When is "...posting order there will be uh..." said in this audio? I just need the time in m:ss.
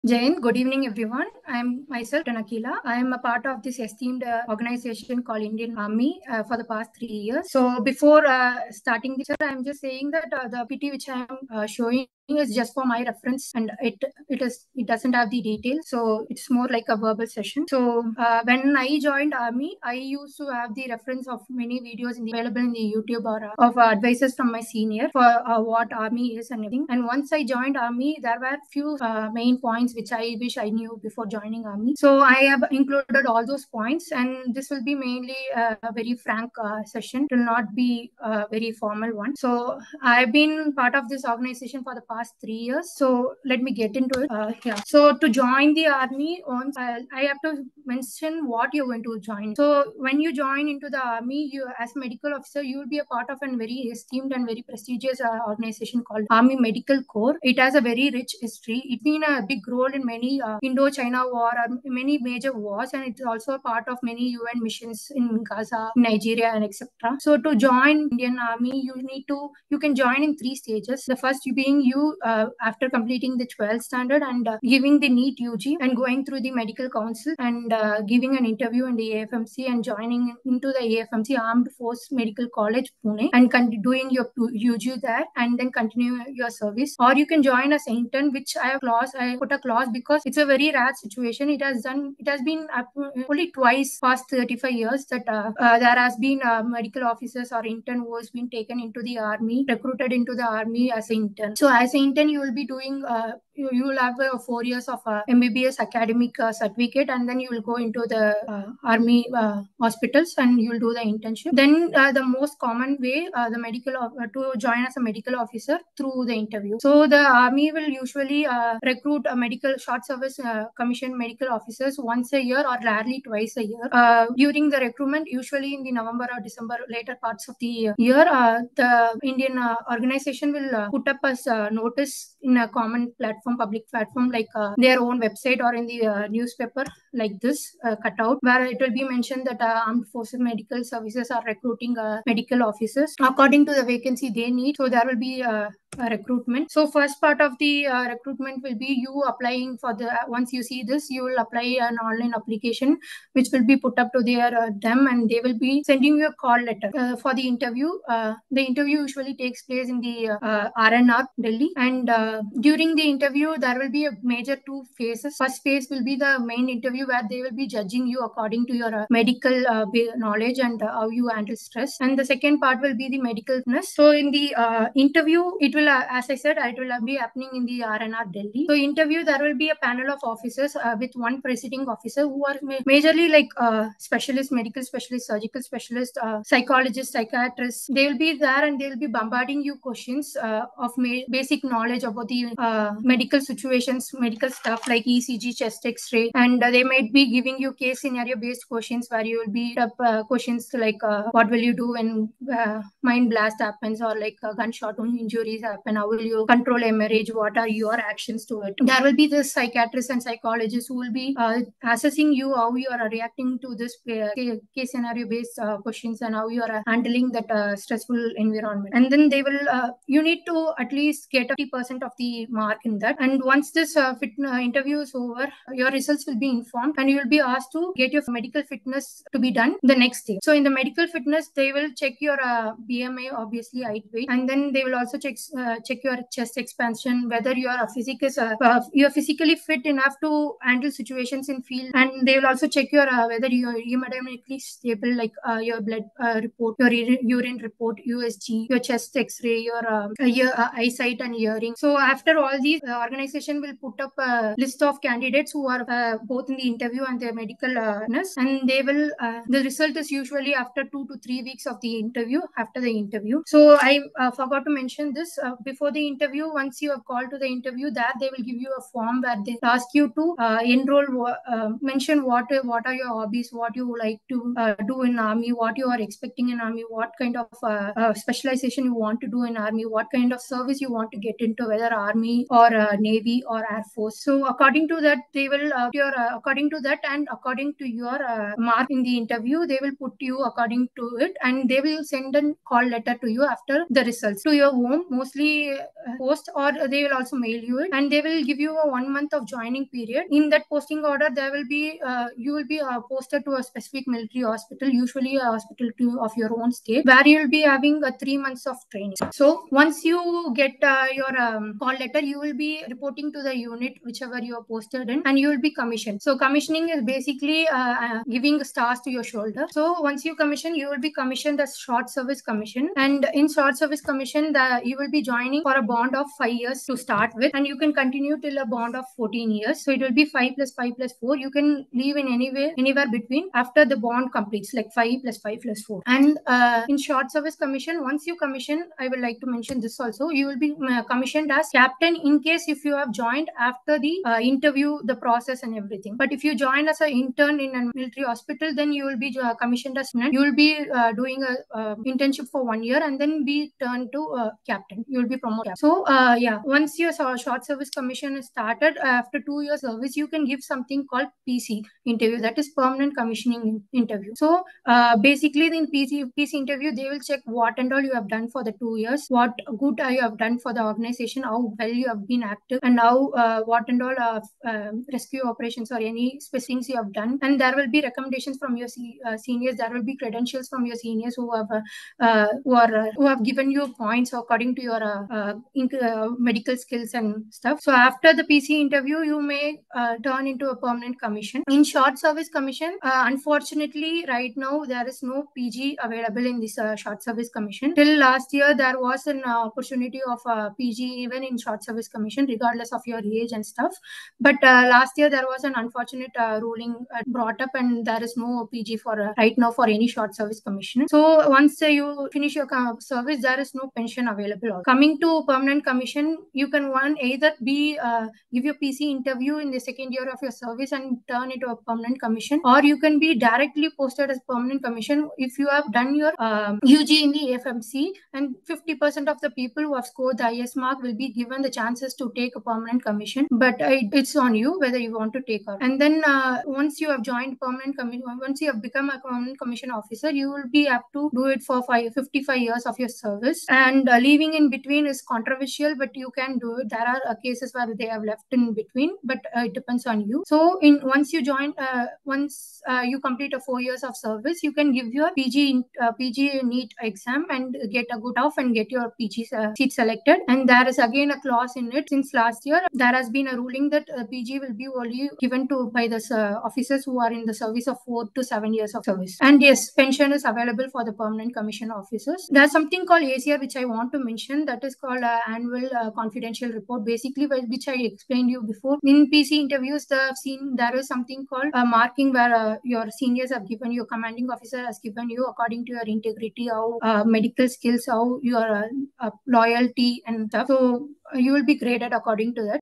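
5:00.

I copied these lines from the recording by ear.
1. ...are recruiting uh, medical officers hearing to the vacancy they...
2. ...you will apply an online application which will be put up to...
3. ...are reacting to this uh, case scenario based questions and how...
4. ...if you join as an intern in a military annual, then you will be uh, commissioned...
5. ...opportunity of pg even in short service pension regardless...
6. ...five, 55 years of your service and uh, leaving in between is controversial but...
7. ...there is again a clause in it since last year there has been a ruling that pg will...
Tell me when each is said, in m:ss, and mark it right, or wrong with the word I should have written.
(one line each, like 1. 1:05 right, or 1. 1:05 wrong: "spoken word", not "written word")
1. 2:21 wrong: "according", not "hearing"
2. 2:31 right
3. 3:32 right
4. 5:46 wrong: "hospital", not "annual"
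5. 6:39 wrong: "commission", not "pension"
6. 7:21 right
7. 7:40 right.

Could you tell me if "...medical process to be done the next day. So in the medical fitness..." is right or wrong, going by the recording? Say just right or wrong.
wrong.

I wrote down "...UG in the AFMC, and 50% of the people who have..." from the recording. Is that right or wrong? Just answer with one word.
right.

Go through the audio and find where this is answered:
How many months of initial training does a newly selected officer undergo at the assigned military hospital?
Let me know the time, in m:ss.
5:08.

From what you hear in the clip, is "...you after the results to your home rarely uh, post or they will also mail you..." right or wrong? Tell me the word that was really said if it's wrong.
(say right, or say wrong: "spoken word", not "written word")
wrong: "mostly", not "rarely".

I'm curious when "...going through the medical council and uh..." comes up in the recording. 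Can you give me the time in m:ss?
1:15.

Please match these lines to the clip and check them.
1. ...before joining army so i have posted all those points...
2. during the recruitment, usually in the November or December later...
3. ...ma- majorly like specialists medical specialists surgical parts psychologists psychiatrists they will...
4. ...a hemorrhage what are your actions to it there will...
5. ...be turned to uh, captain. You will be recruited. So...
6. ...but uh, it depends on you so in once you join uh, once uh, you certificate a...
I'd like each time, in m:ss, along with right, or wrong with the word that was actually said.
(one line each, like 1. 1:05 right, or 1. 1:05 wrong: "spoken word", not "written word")
1. 0:31 wrong: "included", not "posted"
2. 2:04 right
3. 3:02 wrong: "specialists", not "parts"
4. 3:26 right
5. 5:53 wrong: "promoted", not "recruited"
6. 7:29 wrong: "complete", not "certificate".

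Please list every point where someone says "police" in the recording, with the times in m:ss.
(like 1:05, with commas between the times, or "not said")
not said.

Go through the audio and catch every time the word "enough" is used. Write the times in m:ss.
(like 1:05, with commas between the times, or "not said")
3:59.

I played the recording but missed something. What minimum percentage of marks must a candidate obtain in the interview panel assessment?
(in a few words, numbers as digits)
80%.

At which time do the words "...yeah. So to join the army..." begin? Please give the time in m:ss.
0:44.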